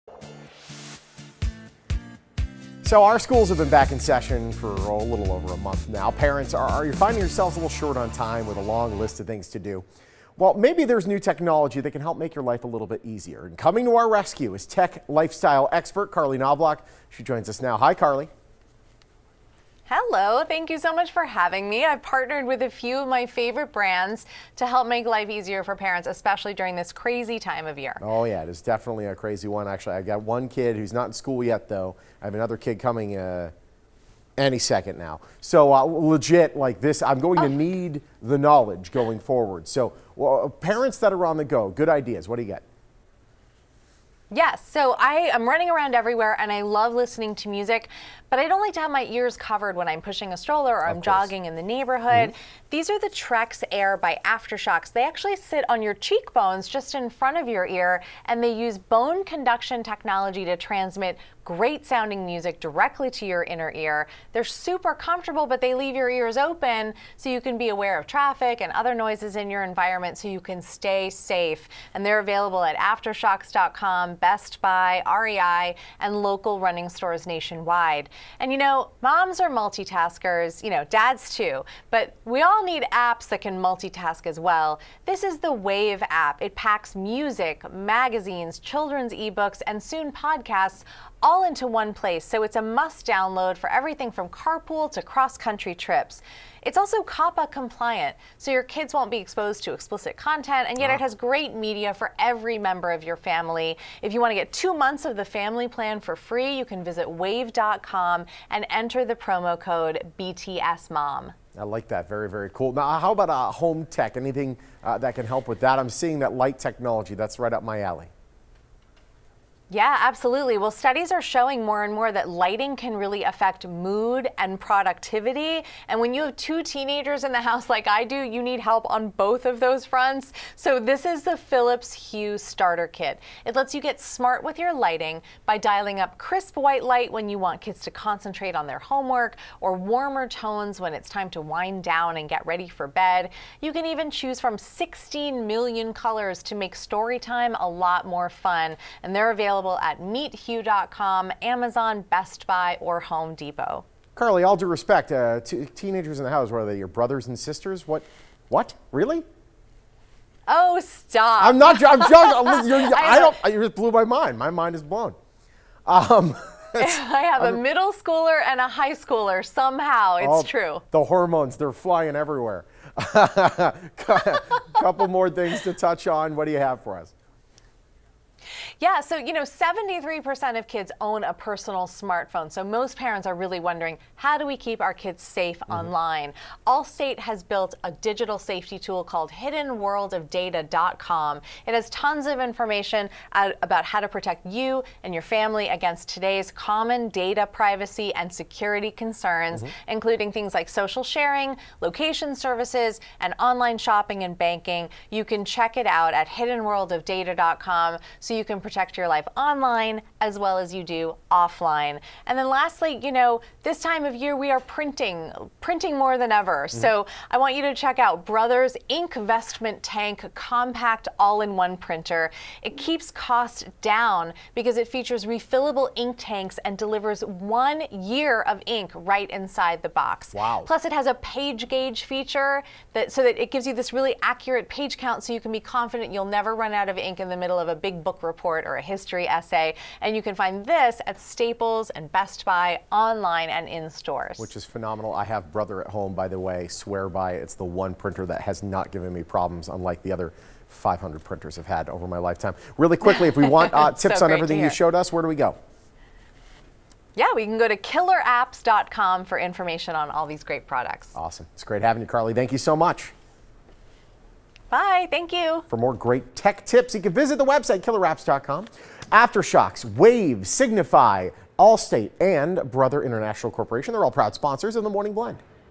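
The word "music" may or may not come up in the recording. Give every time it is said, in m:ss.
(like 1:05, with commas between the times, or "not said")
0:47, 1:02, 1:26.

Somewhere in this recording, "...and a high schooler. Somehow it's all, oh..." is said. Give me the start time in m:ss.
2:48.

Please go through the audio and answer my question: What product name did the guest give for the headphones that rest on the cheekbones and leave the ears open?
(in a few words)
Trekz Air.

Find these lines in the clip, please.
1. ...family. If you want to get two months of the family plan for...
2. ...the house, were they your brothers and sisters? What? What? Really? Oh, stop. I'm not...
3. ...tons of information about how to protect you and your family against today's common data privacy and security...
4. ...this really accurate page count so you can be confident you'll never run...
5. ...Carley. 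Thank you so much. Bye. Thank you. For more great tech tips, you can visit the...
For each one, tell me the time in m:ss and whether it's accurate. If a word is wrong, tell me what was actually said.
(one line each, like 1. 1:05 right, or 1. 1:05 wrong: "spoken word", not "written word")
1. 1:43 right
2. 2:36 right
3. 3:11 right
4. 3:53 right
5. 4:22 right.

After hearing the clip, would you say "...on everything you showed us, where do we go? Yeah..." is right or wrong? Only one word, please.
right.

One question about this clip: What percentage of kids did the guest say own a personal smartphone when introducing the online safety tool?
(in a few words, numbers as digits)
73%.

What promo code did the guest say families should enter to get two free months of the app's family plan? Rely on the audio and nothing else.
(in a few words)
BTSMOM.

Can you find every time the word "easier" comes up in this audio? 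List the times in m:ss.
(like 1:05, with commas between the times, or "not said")
0:13, 0:25.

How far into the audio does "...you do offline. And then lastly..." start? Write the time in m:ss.
3:30.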